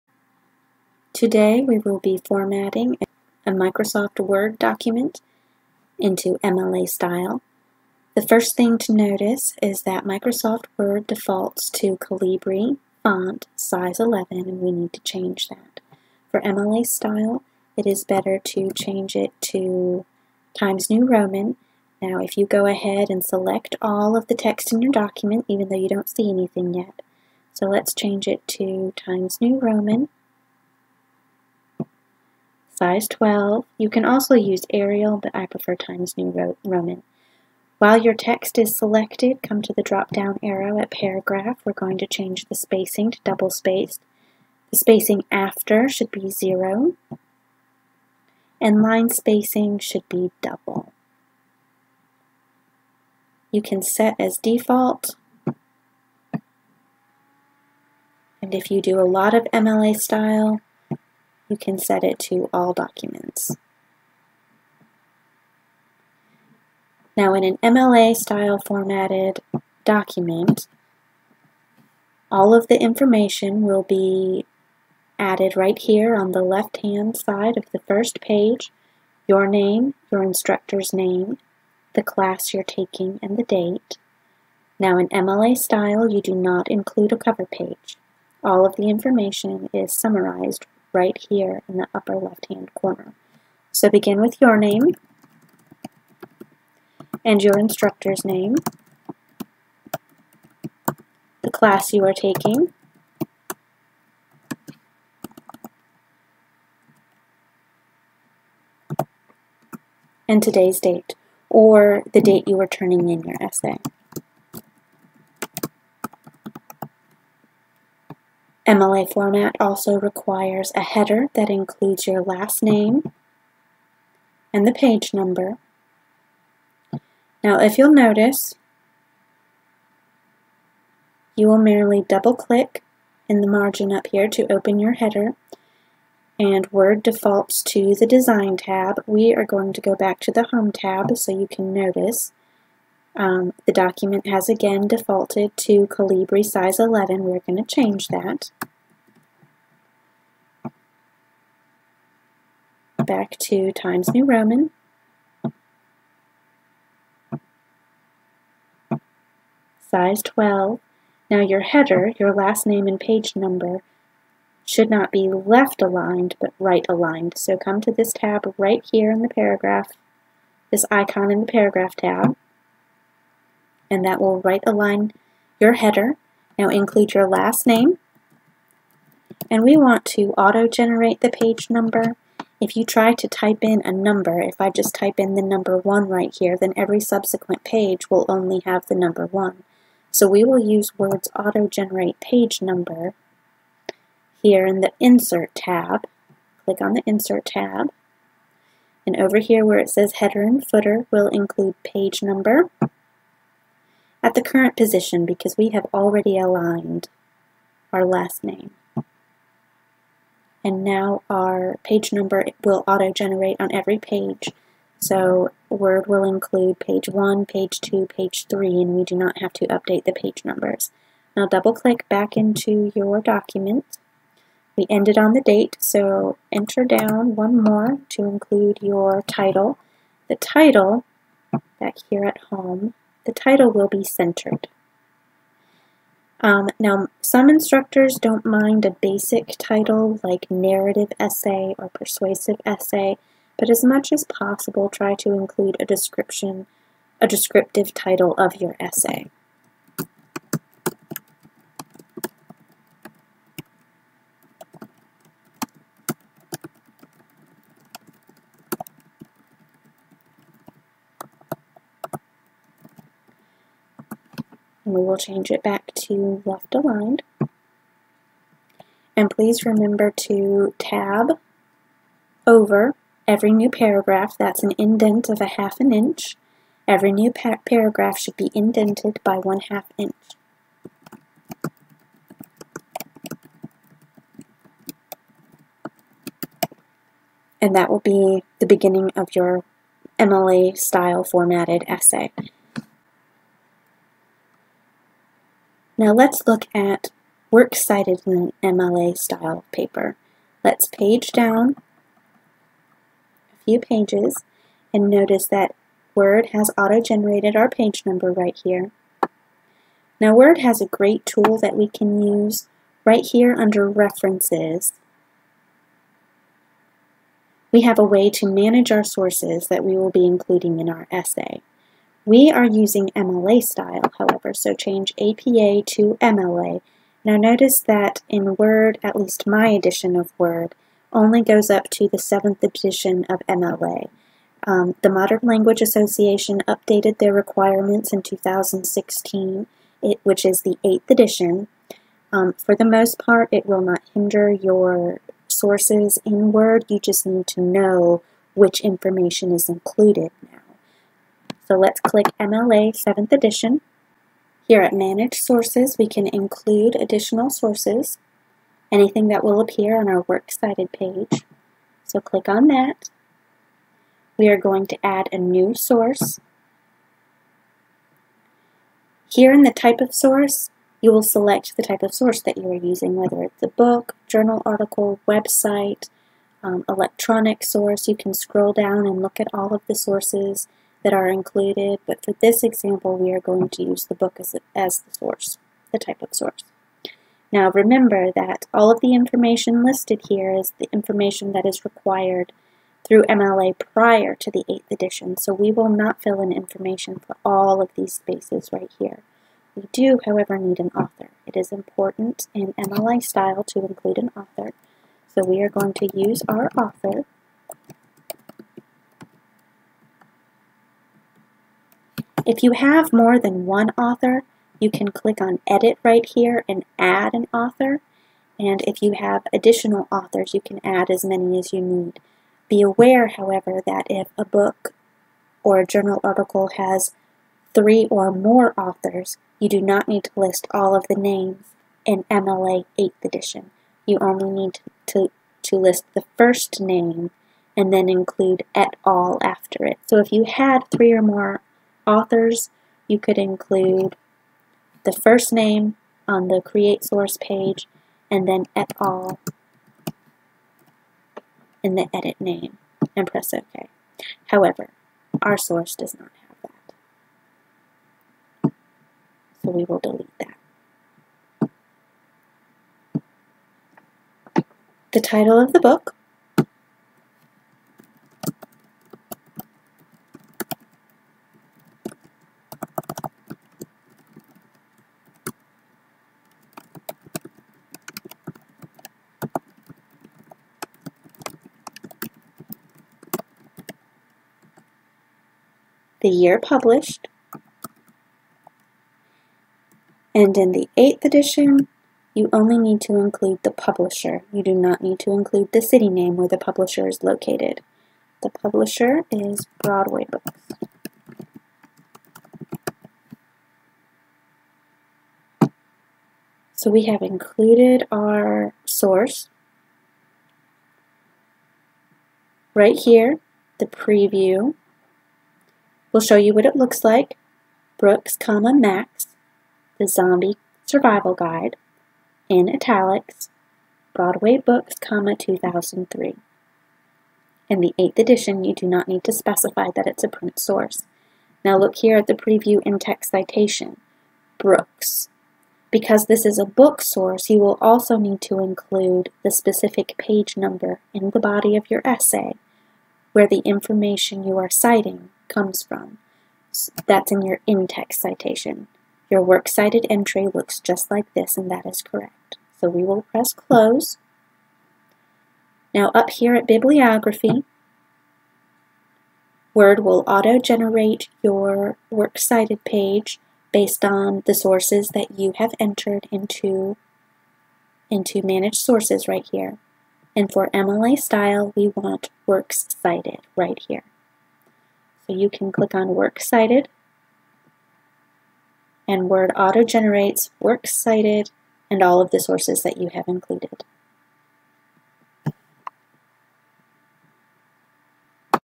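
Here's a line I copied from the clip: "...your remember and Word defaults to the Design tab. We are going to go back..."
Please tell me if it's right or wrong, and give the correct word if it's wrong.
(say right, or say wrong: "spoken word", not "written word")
wrong: "header", not "remember".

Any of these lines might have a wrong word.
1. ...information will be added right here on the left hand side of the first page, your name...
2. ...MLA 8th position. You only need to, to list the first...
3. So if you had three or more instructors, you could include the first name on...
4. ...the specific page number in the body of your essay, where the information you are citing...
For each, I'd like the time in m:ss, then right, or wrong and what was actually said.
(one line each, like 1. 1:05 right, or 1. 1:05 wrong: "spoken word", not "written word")
1. 1:12 right
2. 7:12 wrong: "edition", not "position"
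3. 7:20 wrong: "authors", not "instructors"
4. 8:59 right.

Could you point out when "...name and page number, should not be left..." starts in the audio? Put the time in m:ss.
2:42.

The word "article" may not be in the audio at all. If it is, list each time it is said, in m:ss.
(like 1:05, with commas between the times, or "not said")
6:14, 7:06.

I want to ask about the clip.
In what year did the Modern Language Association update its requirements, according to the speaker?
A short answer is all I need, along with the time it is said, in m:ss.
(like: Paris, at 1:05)
2016, at 5:38.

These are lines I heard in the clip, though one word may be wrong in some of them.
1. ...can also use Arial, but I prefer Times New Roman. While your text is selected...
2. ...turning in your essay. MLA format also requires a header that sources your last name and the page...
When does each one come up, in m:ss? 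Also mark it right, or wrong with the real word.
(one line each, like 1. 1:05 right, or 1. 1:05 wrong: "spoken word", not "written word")
1. 0:33 right
2. 1:52 wrong: "includes", not "sources".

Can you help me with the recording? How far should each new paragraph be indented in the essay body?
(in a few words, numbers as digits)
half an inch.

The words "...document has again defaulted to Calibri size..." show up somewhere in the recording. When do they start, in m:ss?
2:23.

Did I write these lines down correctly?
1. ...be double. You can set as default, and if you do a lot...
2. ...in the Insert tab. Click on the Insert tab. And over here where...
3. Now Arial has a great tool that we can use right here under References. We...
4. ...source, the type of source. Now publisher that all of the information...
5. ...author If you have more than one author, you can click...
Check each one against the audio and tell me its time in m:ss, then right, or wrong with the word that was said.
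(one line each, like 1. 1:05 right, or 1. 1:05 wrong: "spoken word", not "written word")
1. 0:50 right
2. 3:14 right
3. 5:10 wrong: "Word", not "Arial"
4. 6:25 wrong: "remember", not "publisher"
5. 6:46 right.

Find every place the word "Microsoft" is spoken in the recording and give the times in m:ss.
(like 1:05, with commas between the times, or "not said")
0:03, 0:10.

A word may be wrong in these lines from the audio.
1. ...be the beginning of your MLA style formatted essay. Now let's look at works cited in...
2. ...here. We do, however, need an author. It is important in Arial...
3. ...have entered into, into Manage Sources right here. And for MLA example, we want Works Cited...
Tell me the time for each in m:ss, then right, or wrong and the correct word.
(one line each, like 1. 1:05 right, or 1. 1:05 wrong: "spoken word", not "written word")
1. 4:47 right
2. 6:38 wrong: "MLA", not "Arial"
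3. 9:25 wrong: "style", not "example".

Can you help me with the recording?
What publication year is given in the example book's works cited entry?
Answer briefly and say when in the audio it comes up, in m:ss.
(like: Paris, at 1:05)
2003, at 8:45.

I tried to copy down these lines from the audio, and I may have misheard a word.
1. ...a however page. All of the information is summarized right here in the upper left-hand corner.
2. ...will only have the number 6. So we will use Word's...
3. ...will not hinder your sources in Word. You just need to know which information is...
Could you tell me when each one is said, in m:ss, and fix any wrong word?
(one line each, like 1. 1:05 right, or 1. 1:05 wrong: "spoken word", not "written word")
1. 1:27 wrong: "cover", not "however"
2. 3:08 wrong: "1", not "6"
3. 5:43 right.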